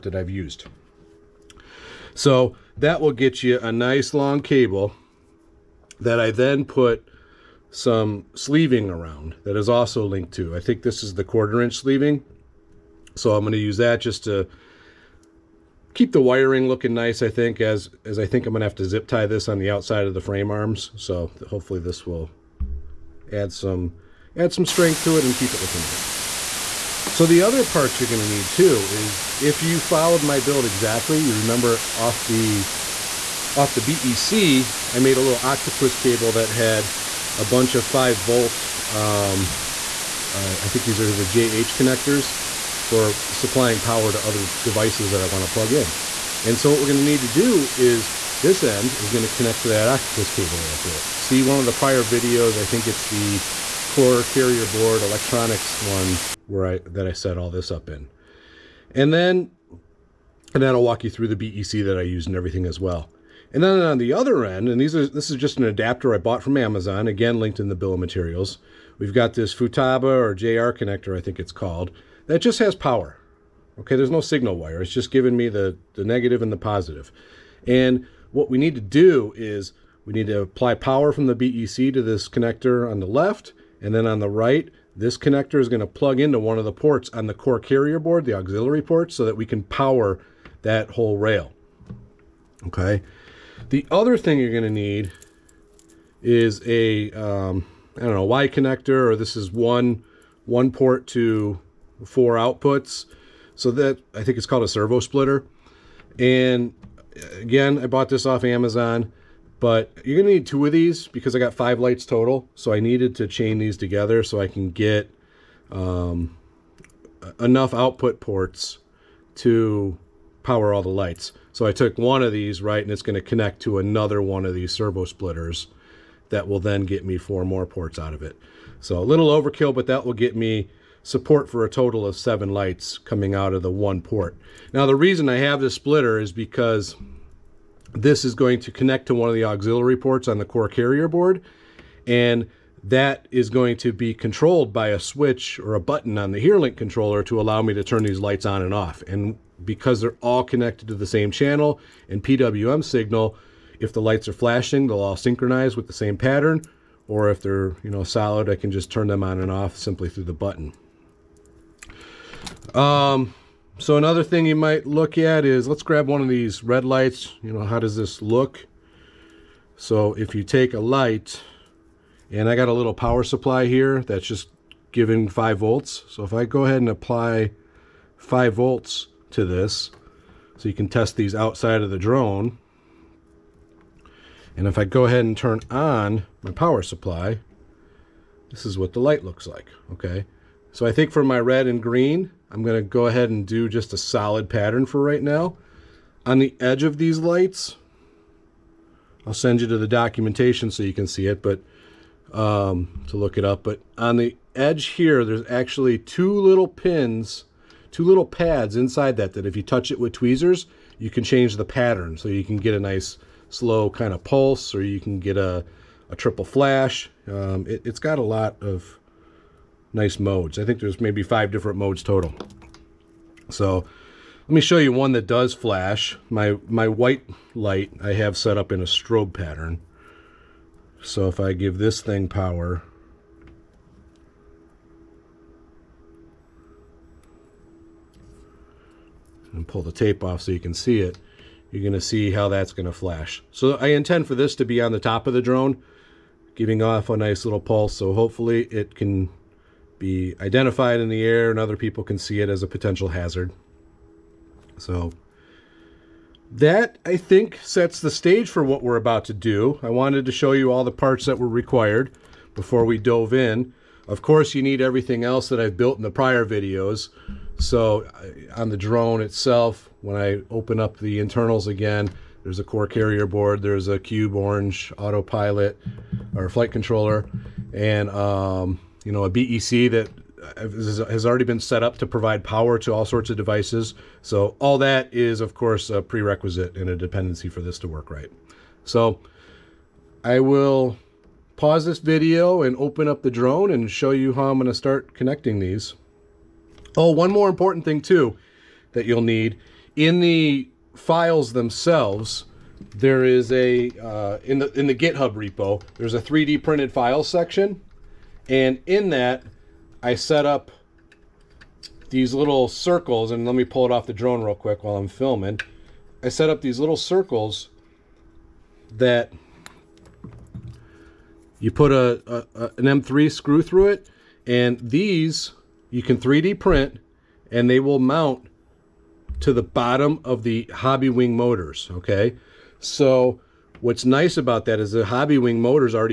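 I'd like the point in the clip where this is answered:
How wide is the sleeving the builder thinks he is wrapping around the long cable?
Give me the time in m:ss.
0:11.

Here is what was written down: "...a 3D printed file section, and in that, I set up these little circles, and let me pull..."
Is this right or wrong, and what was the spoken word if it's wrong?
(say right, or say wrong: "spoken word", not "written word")
right.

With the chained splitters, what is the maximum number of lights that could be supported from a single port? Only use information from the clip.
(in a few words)
7.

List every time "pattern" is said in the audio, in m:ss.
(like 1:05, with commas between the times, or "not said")
2:36, 3:14, 3:31, 3:49.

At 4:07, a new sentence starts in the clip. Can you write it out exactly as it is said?
So hopefully it can be identified in the air and other people can see it as a potential hazard.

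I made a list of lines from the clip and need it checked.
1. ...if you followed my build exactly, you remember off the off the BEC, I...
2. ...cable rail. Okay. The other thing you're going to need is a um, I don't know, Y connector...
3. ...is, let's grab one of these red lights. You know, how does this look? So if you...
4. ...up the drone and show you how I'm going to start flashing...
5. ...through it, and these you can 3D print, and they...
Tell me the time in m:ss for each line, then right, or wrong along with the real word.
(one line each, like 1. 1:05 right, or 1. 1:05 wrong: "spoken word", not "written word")
1. 0:29 right
2. 1:30 wrong: "whole", not "cable"
3. 2:45 right
4. 4:53 wrong: "connecting", not "flashing"
5. 5:23 right.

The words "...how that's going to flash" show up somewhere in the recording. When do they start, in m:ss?
4:02.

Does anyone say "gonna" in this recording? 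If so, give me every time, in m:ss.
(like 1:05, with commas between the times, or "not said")
1:50, 2:03.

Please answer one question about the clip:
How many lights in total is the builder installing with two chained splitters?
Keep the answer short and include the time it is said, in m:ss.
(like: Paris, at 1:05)
5, at 1:51.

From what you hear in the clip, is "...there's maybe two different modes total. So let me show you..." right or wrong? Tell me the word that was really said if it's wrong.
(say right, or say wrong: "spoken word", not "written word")
wrong: "five", not "two".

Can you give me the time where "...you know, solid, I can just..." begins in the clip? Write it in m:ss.
2:37.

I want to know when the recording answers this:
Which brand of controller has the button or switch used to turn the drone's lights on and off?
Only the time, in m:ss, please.
2:26.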